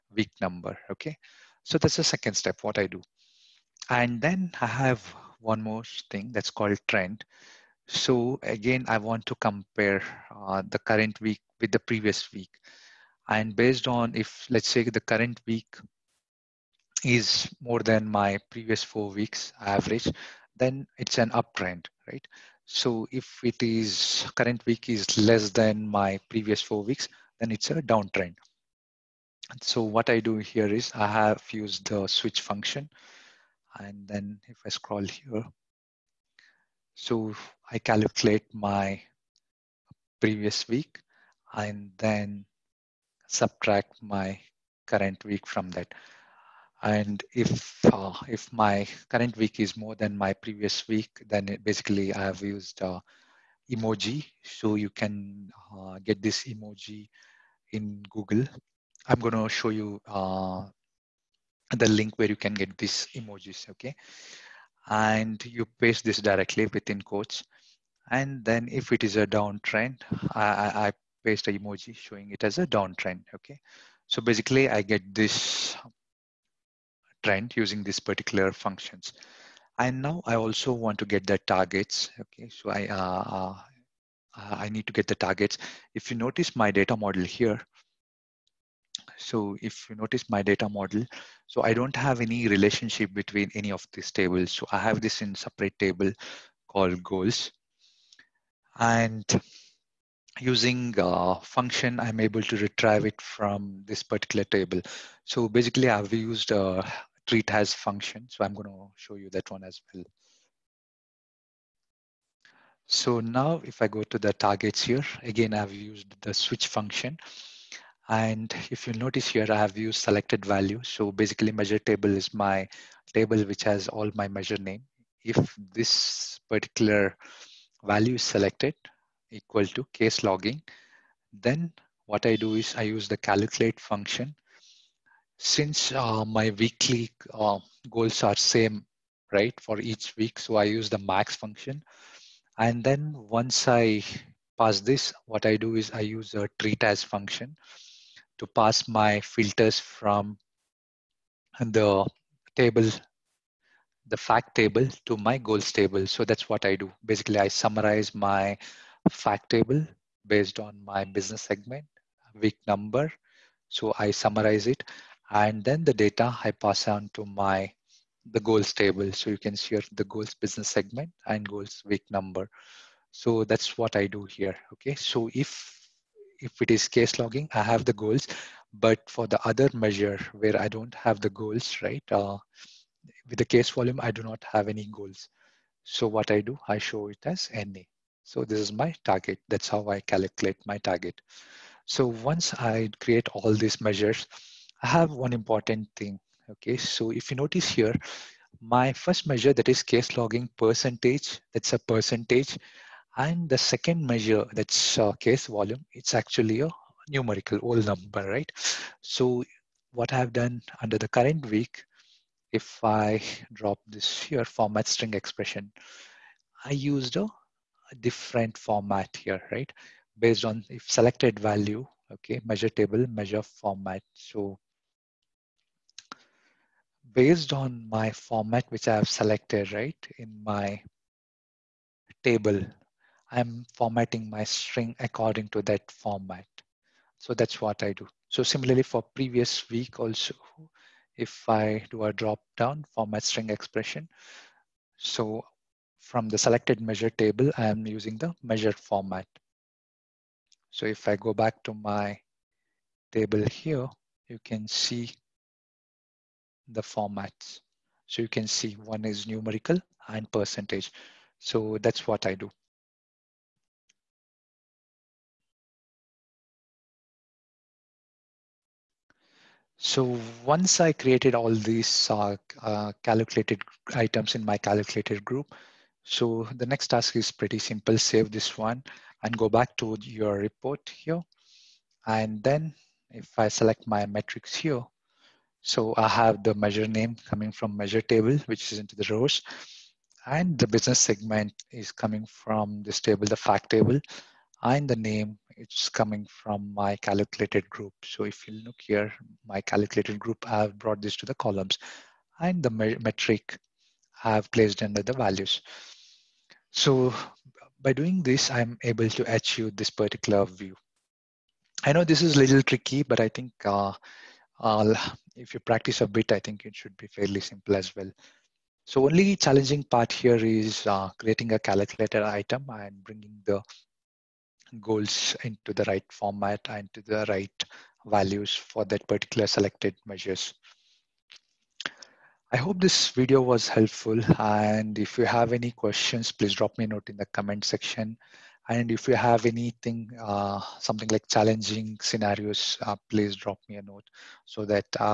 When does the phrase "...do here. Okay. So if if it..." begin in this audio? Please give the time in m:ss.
2:54.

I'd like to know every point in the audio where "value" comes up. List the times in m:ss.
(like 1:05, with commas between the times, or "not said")
2:00, 2:07, 3:41, 5:05, 5:28.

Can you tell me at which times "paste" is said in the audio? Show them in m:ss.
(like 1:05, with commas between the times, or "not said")
1:05, 1:11.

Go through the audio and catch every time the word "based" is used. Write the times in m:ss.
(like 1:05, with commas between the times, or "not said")
0:13, 2:40, 3:40, 3:47.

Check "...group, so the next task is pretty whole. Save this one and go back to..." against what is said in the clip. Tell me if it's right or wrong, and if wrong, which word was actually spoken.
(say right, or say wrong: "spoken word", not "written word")
wrong: "simple", not "whole".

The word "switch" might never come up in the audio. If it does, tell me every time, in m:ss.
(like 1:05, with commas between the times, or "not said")
0:32, 1:56.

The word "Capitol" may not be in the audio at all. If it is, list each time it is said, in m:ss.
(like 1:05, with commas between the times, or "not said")
not said.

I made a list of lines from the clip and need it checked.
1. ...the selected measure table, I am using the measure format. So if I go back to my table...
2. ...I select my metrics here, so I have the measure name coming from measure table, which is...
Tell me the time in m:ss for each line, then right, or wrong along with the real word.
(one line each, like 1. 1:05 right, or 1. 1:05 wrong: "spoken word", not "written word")
1. 4:06 right
2. 4:43 right.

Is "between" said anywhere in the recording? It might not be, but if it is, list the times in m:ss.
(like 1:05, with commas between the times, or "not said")
1:33.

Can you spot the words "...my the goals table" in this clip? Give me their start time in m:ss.
2:47.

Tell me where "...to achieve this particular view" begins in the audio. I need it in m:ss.
5:09.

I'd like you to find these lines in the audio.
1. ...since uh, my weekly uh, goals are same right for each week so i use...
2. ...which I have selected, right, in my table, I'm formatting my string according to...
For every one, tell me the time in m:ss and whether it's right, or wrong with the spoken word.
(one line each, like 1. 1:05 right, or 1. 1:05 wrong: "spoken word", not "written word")
1. 2:15 right
2. 3:48 right.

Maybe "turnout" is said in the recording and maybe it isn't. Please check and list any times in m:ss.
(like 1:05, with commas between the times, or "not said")
not said.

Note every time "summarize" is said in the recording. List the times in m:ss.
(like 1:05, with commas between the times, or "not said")
2:37, 2:44.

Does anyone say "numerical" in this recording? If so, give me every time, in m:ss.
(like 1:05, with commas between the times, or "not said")
3:27, 4:19.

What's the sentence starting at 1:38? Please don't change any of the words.
And using a uh, function, I'm able to retrieve it from this particular table.